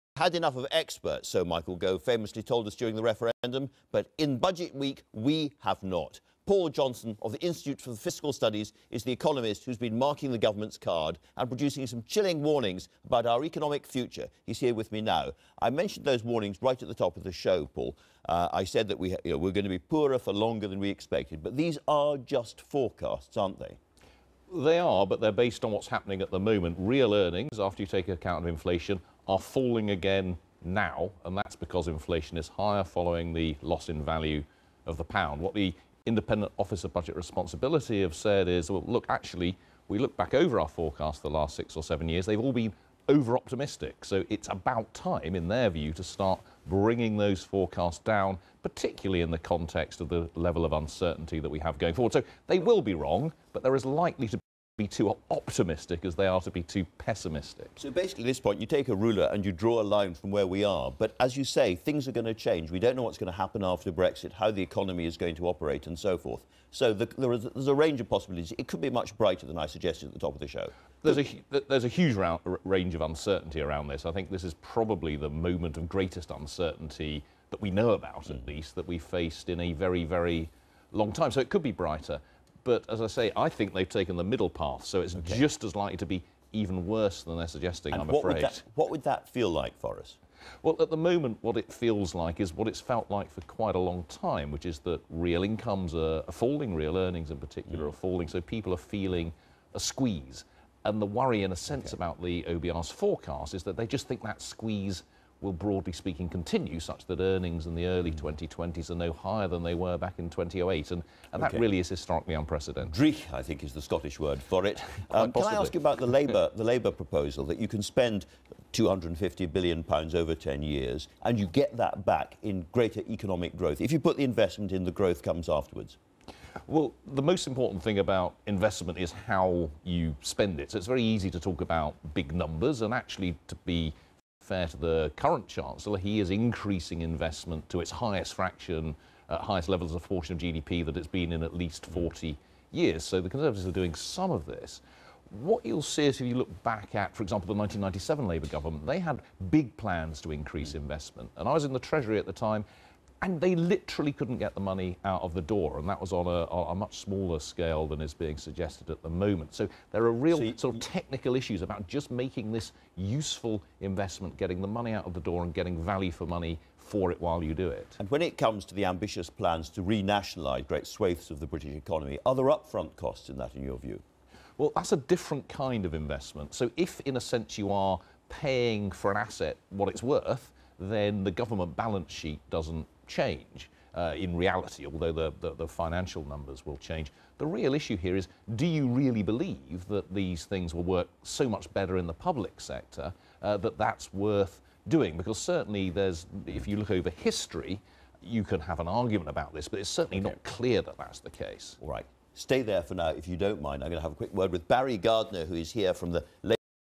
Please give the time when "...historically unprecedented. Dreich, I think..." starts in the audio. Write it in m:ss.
1:51.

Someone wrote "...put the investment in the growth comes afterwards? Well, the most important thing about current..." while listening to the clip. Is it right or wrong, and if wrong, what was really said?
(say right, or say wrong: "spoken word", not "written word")
wrong: "investment", not "current".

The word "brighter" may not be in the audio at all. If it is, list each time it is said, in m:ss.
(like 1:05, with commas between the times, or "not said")
1:09, 1:21.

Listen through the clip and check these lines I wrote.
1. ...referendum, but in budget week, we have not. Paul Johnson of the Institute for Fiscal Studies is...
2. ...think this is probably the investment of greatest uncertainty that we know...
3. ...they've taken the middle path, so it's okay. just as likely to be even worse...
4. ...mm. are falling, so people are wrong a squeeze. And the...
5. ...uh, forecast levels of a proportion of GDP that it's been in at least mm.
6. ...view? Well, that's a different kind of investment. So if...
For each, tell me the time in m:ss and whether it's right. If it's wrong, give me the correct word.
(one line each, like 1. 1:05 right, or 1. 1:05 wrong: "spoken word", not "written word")
1. 0:03 right
2. 1:14 wrong: "moment", not "investment"
3. 1:23 right
4. 1:37 wrong: "feeling", not "wrong"
5. 2:19 wrong: "highest", not "forecast"
6. 2:53 right.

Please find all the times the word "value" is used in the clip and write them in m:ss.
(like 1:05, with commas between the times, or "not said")
0:34, 2:45.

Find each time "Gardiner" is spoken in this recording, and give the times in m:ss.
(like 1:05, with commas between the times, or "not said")
3:24.